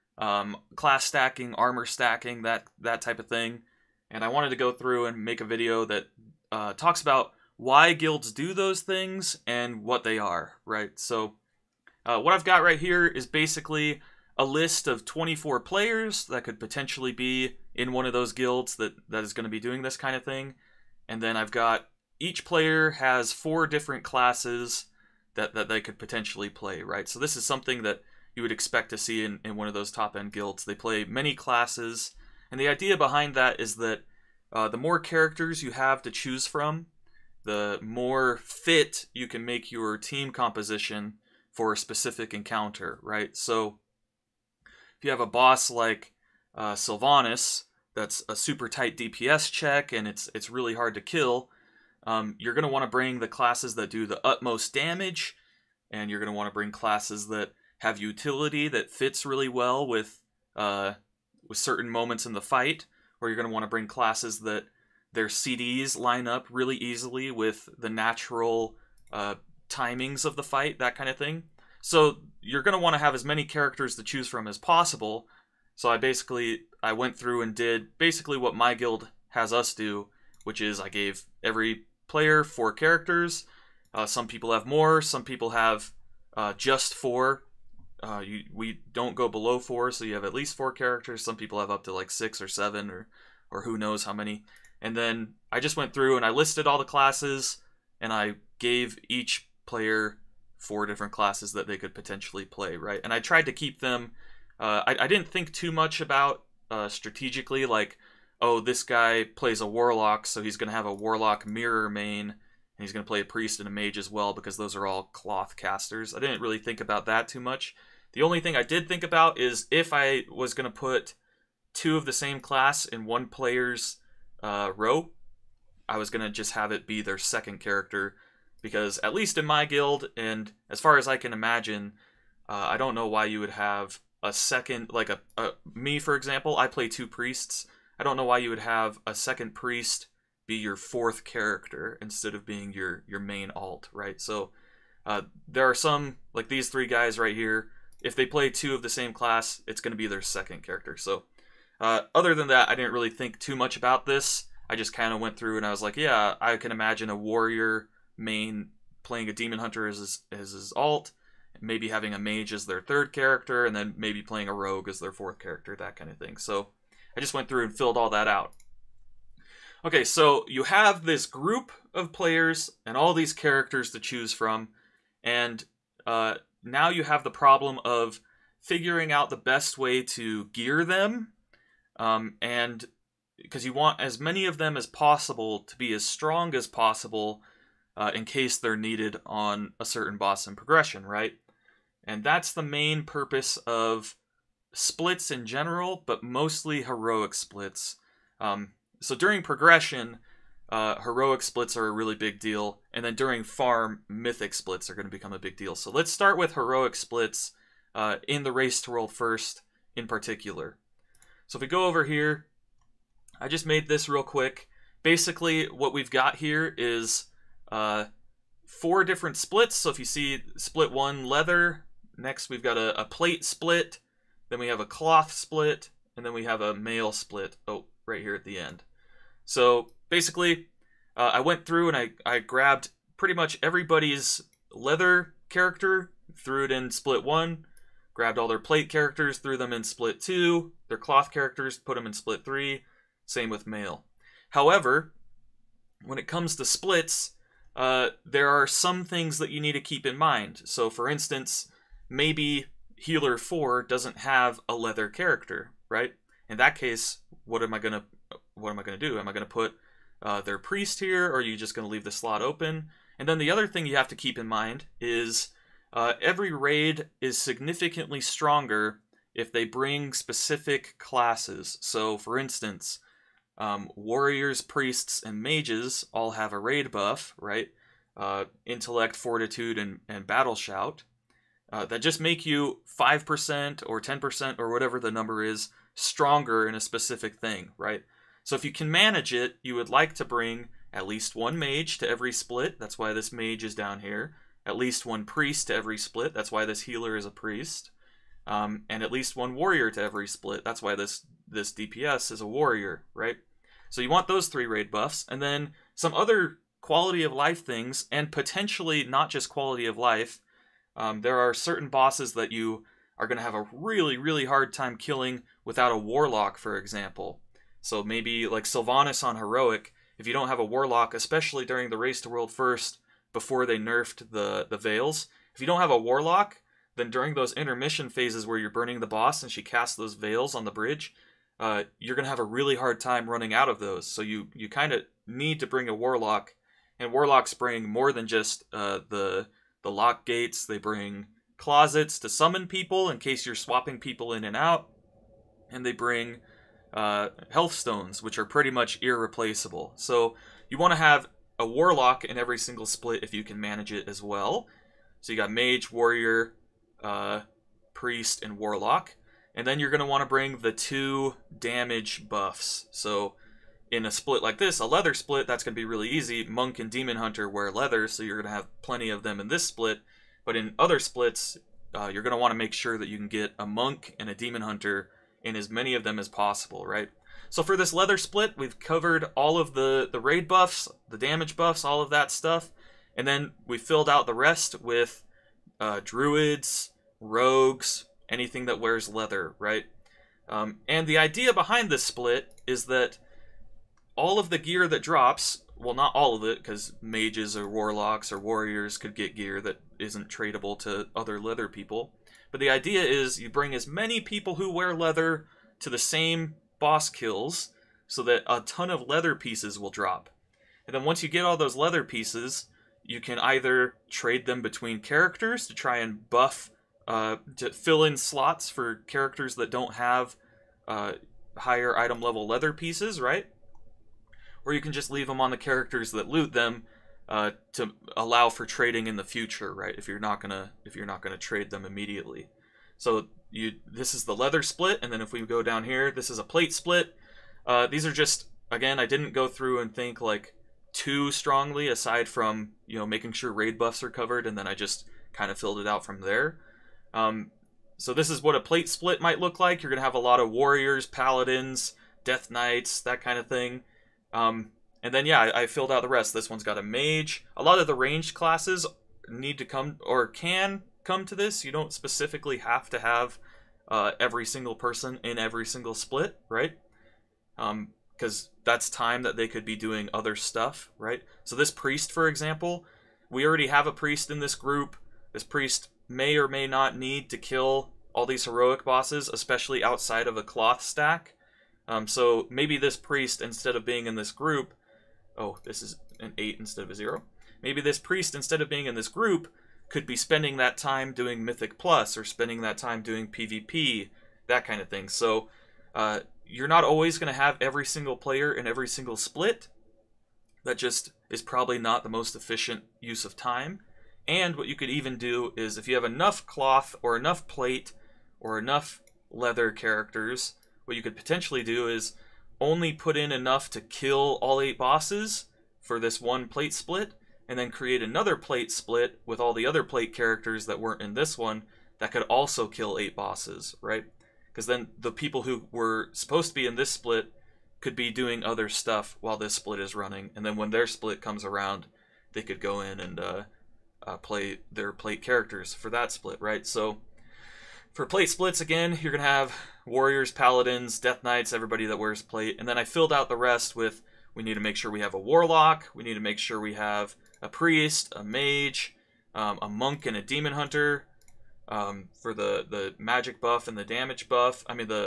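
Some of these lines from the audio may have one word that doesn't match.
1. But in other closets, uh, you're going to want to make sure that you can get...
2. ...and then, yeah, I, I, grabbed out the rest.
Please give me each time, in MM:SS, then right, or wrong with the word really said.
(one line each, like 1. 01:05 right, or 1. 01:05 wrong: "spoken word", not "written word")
1. 06:10 wrong: "splits", not "closets"
2. 07:35 wrong: "filled", not "grabbed".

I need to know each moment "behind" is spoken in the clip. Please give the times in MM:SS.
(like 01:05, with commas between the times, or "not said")
00:32, 06:31.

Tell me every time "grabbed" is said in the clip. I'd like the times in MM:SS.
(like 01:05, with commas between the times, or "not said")
03:52, 03:58.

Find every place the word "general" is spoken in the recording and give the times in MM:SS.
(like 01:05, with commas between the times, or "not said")
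03:15.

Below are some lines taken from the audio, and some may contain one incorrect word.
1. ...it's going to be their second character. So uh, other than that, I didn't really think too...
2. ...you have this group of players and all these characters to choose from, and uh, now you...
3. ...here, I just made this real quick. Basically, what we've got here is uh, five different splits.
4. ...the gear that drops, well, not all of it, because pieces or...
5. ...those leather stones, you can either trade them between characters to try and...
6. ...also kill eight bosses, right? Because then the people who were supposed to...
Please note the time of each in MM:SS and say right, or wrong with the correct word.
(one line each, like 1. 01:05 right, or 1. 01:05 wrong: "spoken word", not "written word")
1. 02:29 right
2. 02:50 right
3. 03:32 wrong: "four", not "five"
4. 06:34 wrong: "mages", not "pieces"
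5. 06:51 wrong: "pieces", not "stones"
6. 08:42 right.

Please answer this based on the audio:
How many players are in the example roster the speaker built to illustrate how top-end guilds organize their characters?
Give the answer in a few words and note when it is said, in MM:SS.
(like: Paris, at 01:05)
24, at 00:15.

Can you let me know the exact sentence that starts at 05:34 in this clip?
So you, you kind of need to bring a Warlock, and Warlocks bring more than just uh, the, the lock gates.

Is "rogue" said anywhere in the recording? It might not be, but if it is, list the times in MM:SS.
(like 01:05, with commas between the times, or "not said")
02:44, 06:27.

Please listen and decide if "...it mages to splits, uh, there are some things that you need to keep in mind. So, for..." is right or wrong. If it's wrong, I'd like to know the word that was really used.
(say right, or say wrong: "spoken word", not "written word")
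wrong: "comes", not "mages".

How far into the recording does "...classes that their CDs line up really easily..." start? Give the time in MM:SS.
01:03.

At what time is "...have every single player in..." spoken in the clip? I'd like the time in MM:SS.
08:17.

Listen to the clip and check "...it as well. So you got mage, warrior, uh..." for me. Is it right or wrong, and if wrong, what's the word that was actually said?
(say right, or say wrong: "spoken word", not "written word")
right.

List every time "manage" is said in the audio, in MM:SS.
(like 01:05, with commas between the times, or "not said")
04:48, 05:53.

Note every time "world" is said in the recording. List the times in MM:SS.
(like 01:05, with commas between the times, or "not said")
03:28, 05:22.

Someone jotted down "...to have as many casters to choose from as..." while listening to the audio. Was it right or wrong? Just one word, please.
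wrong.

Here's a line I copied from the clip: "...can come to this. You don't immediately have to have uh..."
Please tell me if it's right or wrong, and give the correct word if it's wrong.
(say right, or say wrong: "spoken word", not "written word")
wrong: "specifically", not "immediately".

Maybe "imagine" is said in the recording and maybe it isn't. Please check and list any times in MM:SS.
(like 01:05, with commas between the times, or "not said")
02:11, 02:36.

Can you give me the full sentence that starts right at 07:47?
Because um, that's time that they could be doing other stuff, right?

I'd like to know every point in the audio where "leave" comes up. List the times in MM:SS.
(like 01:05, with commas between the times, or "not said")
04:21, 07:05.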